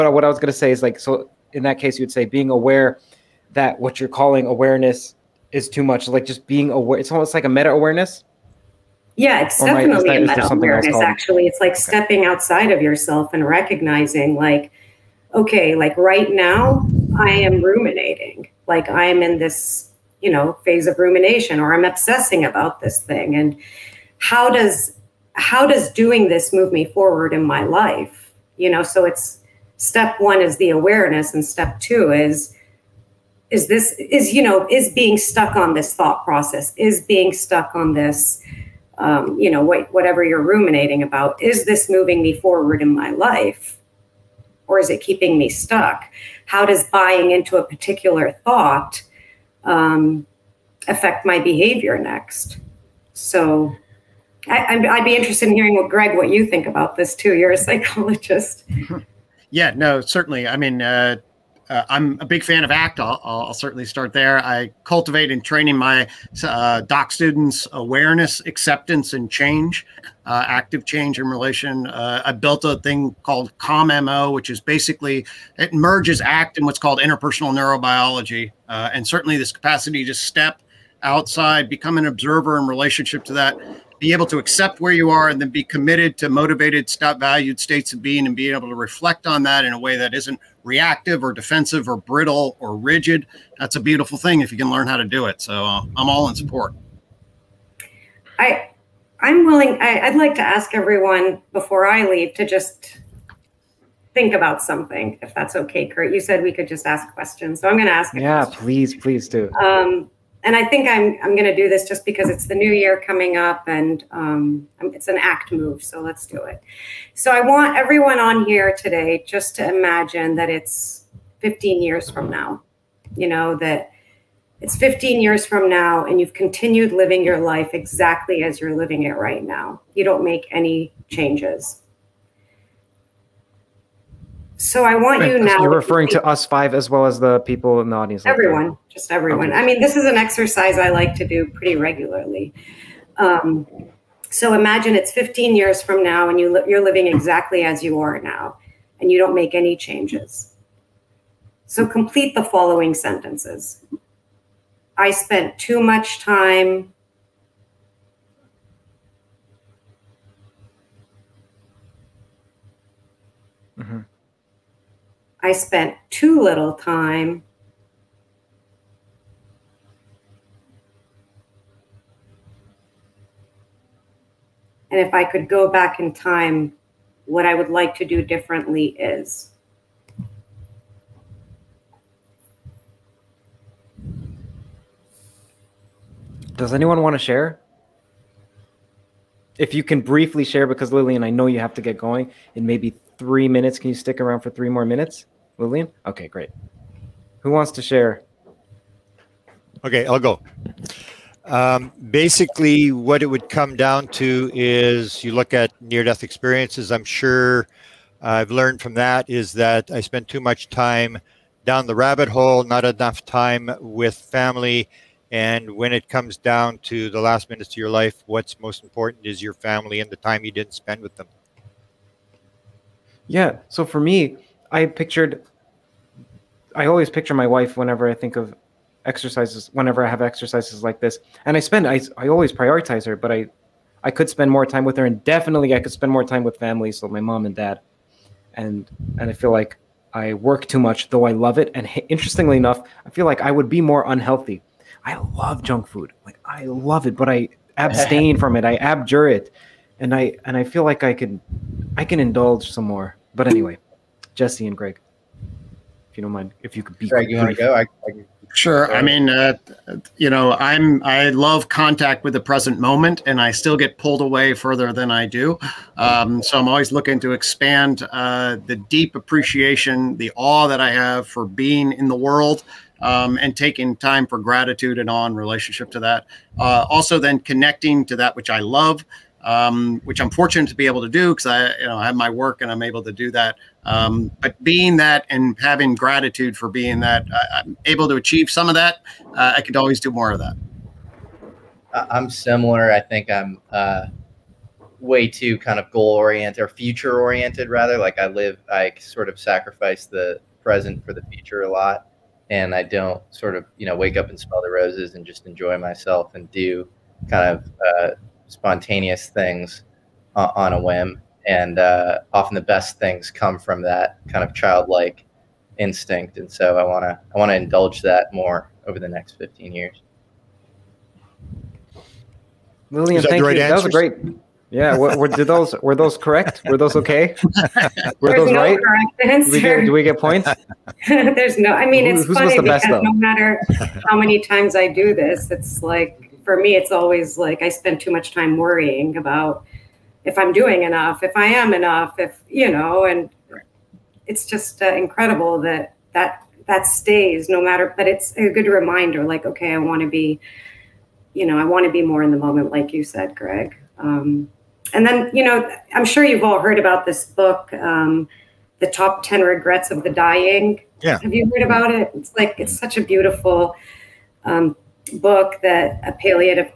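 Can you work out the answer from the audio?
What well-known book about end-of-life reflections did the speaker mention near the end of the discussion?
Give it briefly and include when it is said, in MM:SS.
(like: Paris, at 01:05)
The Top Ten Regrets of the Dying, at 05:58.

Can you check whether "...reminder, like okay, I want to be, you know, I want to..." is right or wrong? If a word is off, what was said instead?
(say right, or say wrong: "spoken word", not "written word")
right.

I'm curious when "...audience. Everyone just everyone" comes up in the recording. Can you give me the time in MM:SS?
02:17.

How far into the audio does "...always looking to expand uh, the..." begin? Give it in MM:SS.
04:26.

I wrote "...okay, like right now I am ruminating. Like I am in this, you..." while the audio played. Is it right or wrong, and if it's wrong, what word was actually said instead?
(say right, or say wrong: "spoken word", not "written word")
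right.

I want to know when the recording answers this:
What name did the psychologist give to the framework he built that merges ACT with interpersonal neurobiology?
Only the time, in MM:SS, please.
01:13.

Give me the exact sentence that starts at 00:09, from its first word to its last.
Yeah, it's or definitely that, a meta awareness.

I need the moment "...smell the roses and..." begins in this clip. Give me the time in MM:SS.
05:04.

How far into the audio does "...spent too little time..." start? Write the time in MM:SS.
02:45.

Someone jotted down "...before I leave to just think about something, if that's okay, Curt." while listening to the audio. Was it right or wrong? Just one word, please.
right.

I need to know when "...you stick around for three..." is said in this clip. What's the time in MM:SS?
03:13.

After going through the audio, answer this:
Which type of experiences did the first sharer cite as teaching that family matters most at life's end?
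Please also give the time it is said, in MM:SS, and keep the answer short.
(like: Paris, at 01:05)
near death experiences, at 03:25.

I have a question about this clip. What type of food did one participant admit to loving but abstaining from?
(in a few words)
junk food.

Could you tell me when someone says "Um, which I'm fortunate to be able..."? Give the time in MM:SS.
04:39.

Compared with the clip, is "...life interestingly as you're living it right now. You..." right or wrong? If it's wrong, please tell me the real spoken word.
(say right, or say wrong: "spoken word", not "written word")
wrong: "exactly", not "interestingly".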